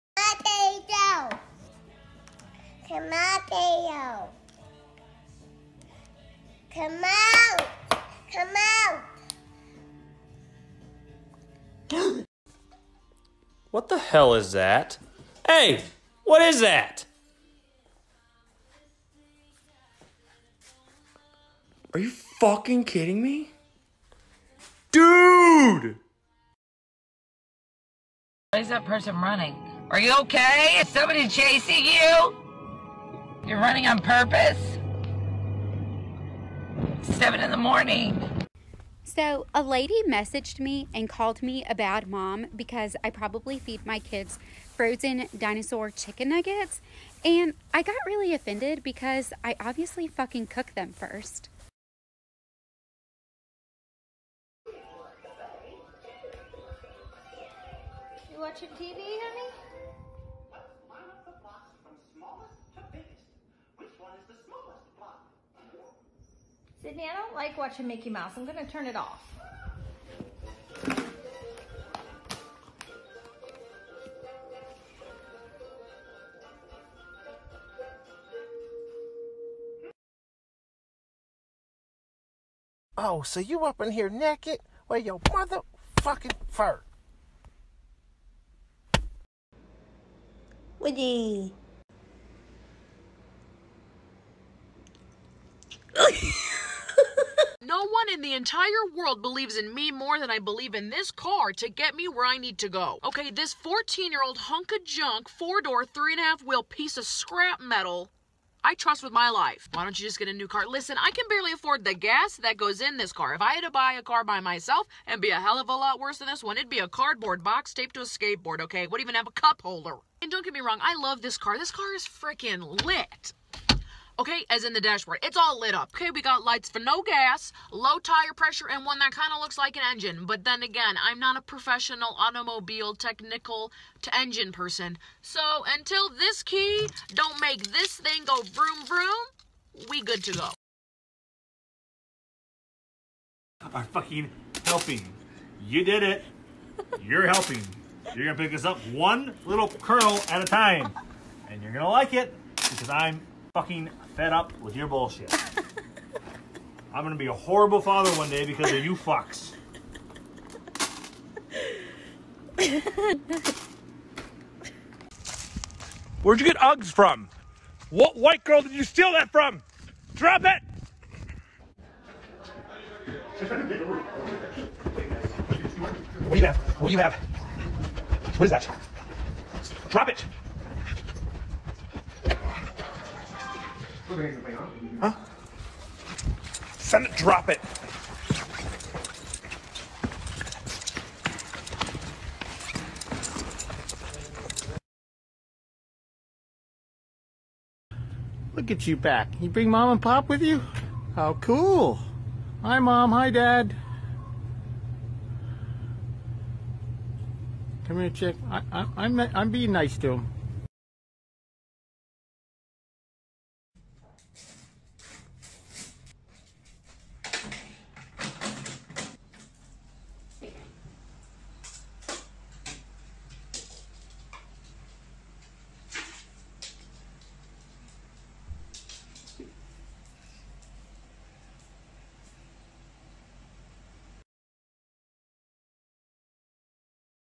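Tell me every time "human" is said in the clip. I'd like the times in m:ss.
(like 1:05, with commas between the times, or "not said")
not said.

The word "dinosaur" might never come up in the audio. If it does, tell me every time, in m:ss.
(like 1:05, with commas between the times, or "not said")
0:45.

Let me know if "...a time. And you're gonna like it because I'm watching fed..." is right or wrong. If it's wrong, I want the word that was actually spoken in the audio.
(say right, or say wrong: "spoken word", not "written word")
wrong: "fucking", not "watching".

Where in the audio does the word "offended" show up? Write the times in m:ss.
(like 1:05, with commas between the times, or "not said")
0:48.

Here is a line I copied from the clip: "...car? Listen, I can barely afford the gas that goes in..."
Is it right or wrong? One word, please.
right.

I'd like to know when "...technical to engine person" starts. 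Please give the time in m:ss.
2:12.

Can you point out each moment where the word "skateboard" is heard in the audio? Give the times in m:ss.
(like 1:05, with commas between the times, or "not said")
1:58.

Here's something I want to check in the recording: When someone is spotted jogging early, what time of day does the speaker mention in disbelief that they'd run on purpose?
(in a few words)
7 in the morning.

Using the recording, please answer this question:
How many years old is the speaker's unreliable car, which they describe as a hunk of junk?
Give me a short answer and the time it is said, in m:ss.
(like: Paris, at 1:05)
14, at 1:43.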